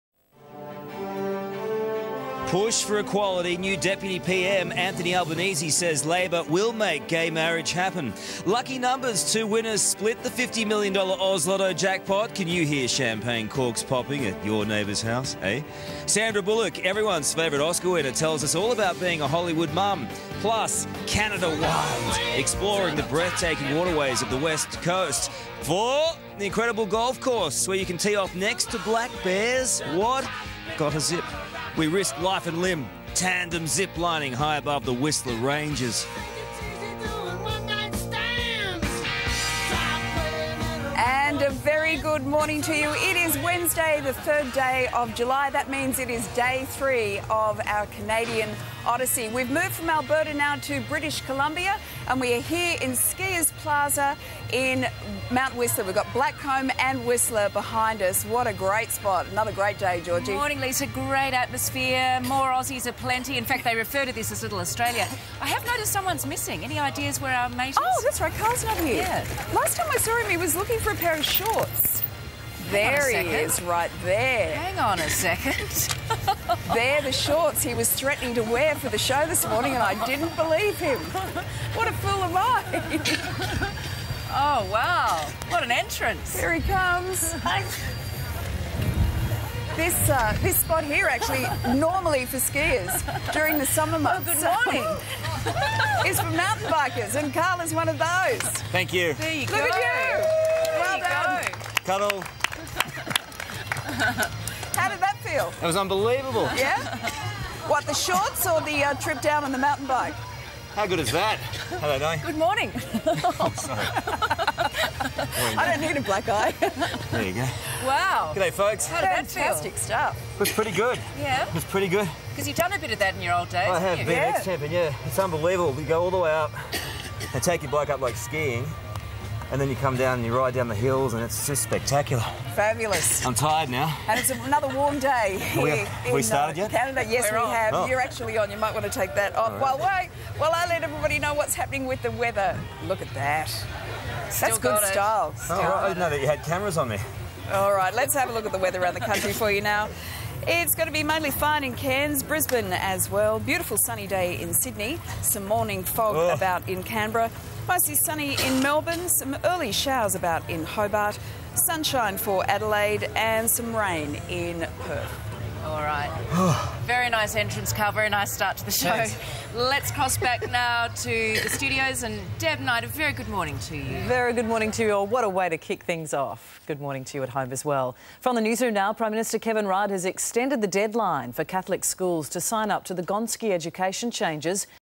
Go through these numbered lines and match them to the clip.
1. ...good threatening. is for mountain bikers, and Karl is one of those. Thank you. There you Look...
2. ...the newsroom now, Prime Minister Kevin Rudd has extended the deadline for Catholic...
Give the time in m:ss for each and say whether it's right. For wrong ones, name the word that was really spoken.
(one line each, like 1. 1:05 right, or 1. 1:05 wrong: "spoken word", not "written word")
1. 1:34 wrong: "morning", not "threatening"
2. 2:58 right.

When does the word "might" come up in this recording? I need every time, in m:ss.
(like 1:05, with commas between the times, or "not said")
2:18.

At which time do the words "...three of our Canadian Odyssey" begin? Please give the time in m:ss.
0:46.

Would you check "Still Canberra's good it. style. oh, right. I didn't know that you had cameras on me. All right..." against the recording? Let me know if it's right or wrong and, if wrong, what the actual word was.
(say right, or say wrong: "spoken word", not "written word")
wrong: "That", not "Canberra".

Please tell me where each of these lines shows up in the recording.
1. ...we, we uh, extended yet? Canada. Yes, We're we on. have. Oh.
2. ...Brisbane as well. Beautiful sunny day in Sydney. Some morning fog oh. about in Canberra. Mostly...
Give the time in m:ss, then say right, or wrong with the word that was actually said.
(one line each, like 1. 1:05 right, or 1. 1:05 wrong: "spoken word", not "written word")
1. 2:16 wrong: "started", not "extended"
2. 2:32 right.